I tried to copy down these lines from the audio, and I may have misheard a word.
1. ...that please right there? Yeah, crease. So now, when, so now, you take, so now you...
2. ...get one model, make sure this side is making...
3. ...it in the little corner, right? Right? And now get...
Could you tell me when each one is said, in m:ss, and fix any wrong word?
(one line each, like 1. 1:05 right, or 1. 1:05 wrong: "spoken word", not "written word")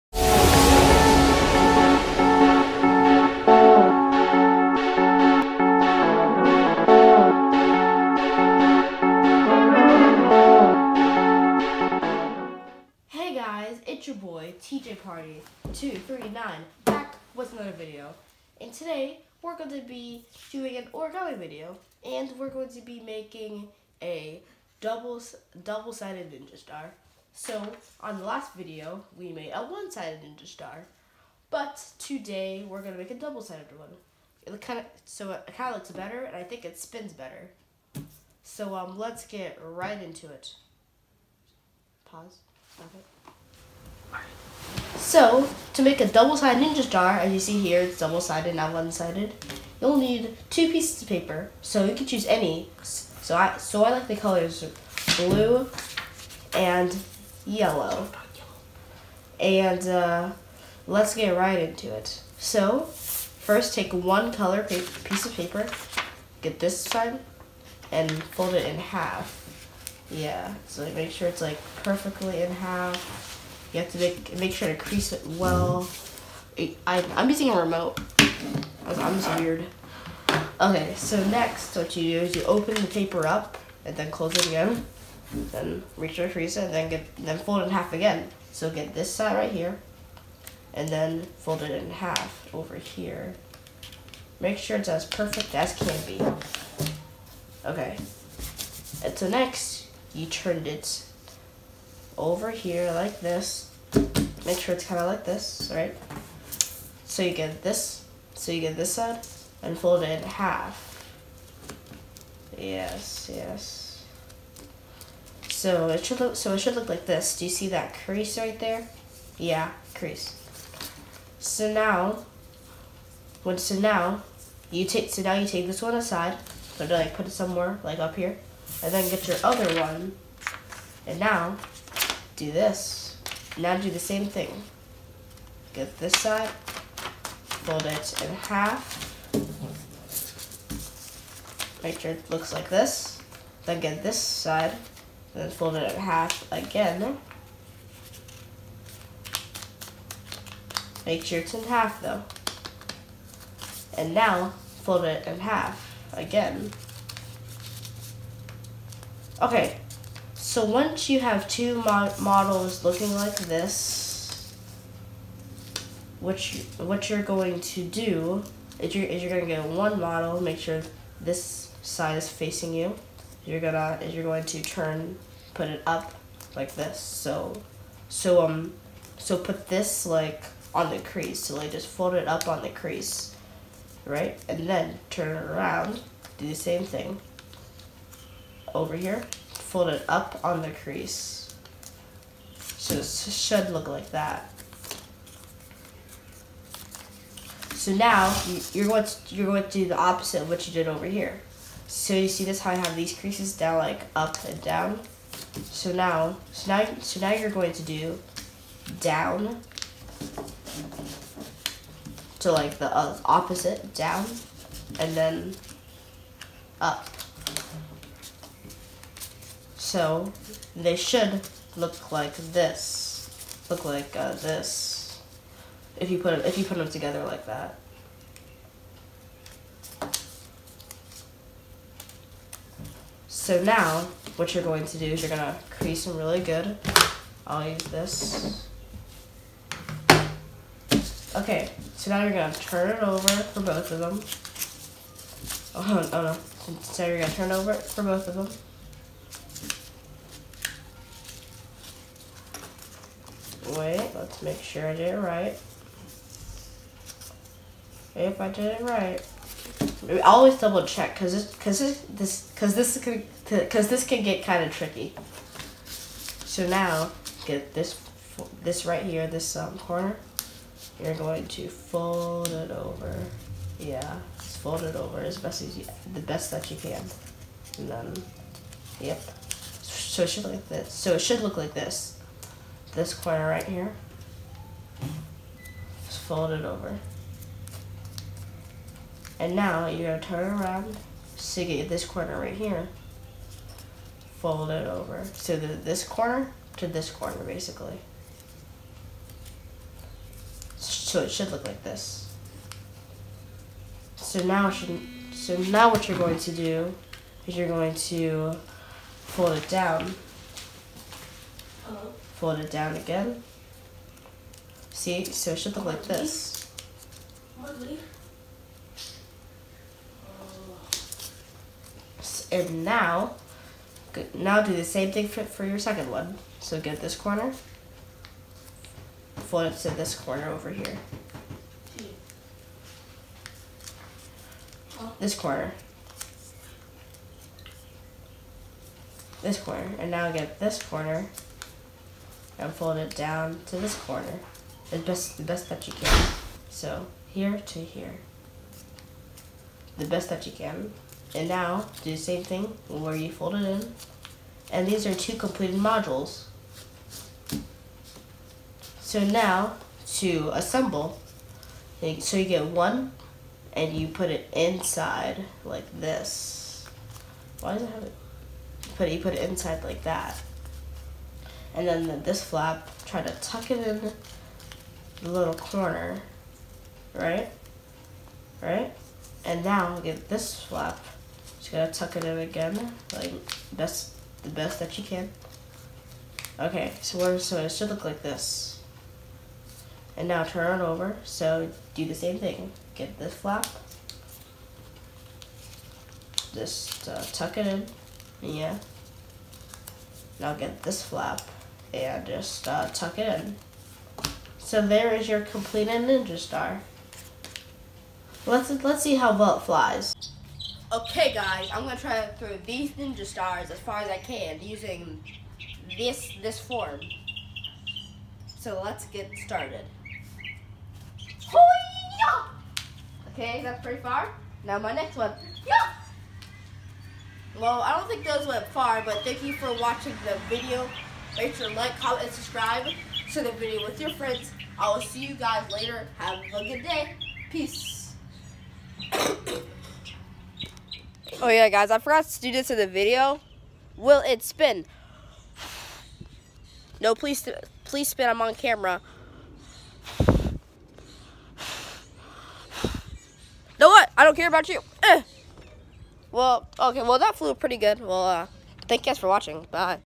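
1. 1:57 wrong: "crease", not "please"
2. 2:49 wrong: "facing", not "making"
3. 6:13 right.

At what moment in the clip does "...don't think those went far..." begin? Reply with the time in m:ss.
7:07.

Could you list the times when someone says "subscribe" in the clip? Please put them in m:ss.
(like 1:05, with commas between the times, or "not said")
7:12.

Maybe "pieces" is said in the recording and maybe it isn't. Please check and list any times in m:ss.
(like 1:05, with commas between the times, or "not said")
0:50, 1:04.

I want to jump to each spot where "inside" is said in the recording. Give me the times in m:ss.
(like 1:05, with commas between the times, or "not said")
6:04, 6:09.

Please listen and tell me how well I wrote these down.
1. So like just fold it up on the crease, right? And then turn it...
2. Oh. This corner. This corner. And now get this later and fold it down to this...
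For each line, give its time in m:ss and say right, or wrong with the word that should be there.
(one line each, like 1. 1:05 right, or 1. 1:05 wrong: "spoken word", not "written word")
1. 3:01 right
2. 5:34 wrong: "corner", not "later".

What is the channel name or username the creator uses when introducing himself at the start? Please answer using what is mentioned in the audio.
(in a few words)
Tjpardy 239.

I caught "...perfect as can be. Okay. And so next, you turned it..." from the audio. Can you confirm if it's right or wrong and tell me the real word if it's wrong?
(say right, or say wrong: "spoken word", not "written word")
right.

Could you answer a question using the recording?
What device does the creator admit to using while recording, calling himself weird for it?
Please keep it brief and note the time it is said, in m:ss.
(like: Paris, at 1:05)
a remote, at 1:17.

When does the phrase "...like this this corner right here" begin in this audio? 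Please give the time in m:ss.
4:41.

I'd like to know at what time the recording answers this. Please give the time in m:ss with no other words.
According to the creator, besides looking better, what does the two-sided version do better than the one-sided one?
0:36.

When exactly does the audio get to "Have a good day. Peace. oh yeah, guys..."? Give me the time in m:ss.
7:16.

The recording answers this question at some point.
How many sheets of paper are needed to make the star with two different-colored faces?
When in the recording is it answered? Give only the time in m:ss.
0:50.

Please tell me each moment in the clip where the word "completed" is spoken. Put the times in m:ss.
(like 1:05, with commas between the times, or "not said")
5:55, 6:45.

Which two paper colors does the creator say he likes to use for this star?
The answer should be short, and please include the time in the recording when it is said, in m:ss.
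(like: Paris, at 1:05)
blue and yellow, at 0:55.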